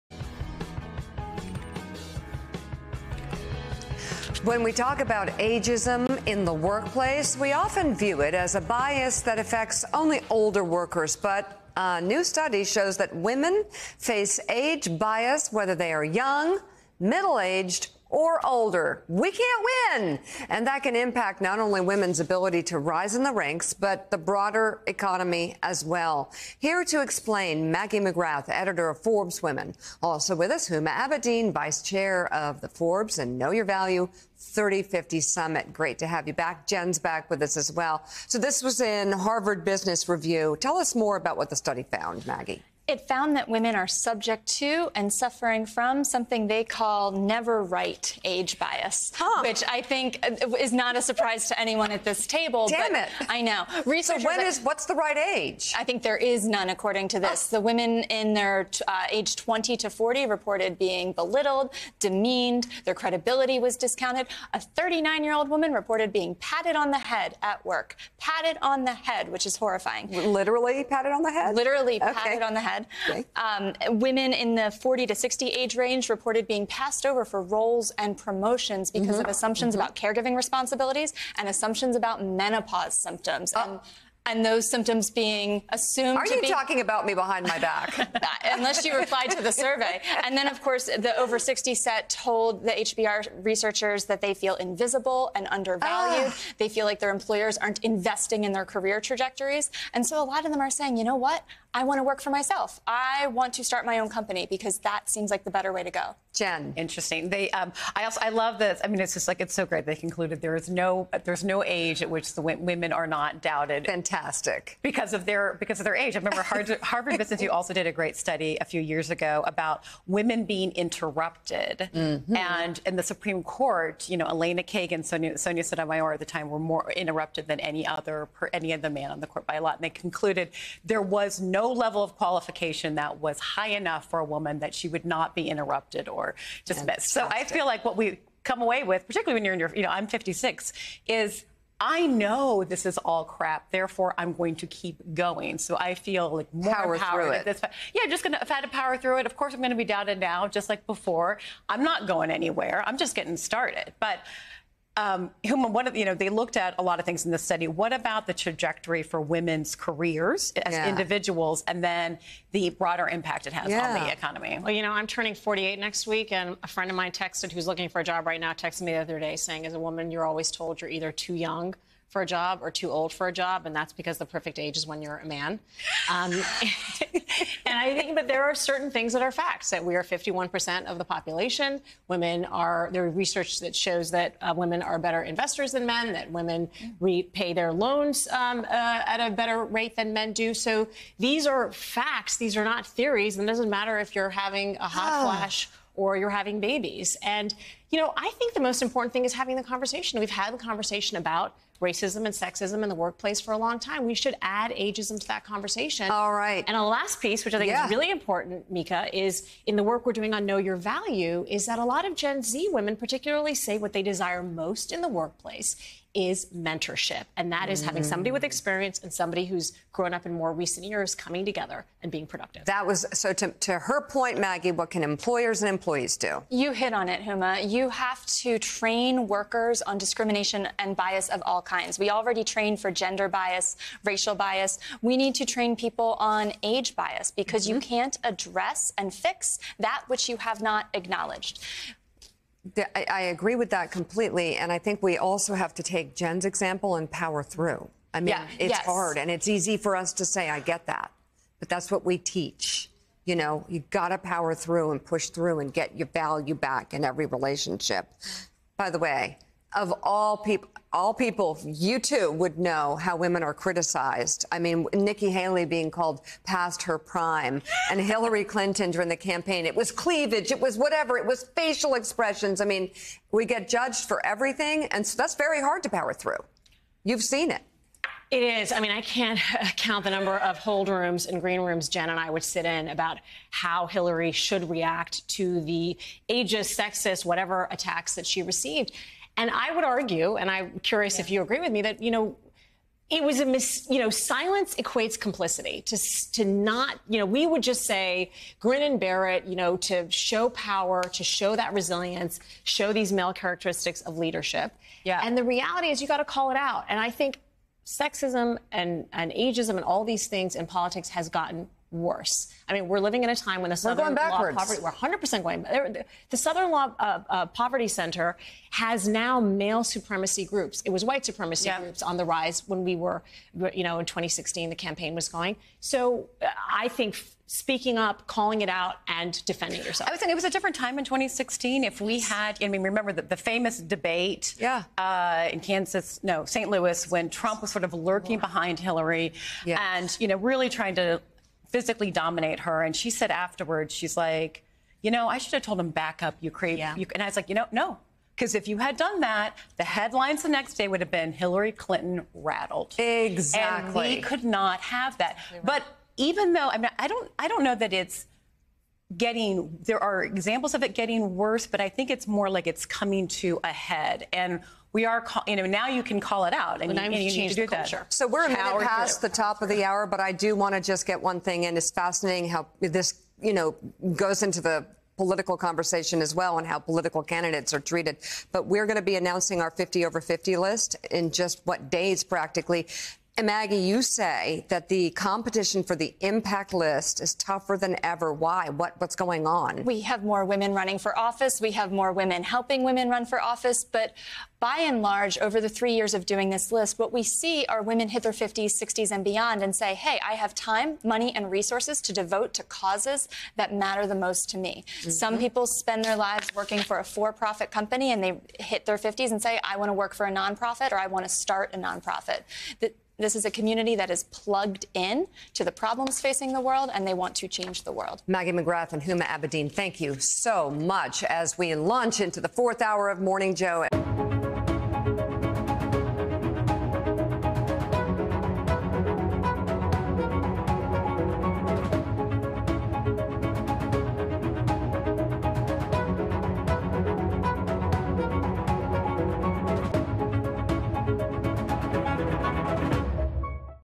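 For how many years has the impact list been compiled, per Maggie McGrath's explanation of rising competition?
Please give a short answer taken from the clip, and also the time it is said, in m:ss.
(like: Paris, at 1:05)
3 years, at 6:35.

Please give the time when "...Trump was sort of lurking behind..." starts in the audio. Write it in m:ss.
5:37.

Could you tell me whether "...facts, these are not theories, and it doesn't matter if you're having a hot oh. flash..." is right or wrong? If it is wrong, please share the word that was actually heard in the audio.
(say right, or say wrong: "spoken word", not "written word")
right.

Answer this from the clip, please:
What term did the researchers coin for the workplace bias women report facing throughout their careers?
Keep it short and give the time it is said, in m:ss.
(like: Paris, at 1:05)
never right age bias, at 0:47.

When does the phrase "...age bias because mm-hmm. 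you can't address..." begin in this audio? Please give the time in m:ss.
3:56.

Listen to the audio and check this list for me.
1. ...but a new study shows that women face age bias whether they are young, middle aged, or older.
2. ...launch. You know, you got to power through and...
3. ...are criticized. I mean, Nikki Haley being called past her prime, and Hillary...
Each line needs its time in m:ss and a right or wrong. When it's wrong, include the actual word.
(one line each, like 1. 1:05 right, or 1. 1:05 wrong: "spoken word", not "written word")
1. 0:11 right
2. 4:12 wrong: "teach", not "launch"
3. 4:23 right.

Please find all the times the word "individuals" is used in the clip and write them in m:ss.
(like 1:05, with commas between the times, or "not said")
2:40.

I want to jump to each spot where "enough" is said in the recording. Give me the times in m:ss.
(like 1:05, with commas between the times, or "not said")
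2:13.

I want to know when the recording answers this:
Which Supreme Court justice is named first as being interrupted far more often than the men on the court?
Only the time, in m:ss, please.
2:04.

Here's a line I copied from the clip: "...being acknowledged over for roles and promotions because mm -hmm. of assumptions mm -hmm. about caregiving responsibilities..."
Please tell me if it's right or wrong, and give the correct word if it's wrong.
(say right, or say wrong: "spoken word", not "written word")
wrong: "passed", not "acknowledged".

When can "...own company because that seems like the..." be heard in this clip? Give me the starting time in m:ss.
1:43.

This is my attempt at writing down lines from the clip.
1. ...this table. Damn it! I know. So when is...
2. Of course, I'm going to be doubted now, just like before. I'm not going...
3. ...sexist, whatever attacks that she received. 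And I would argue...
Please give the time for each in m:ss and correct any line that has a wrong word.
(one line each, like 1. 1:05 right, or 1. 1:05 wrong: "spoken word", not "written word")
1. 0:52 right
2. 2:29 right
3. 4:46 right.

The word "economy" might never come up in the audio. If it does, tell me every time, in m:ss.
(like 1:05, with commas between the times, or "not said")
0:24, 2:44.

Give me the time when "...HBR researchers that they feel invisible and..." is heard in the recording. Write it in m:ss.
1:32.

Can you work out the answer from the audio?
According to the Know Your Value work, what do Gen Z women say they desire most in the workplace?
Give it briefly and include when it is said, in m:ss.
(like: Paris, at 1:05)
Mentorship, at 3:36.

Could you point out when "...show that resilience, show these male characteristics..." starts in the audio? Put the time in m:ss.
5:01.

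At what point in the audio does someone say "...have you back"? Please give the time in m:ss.
0:36.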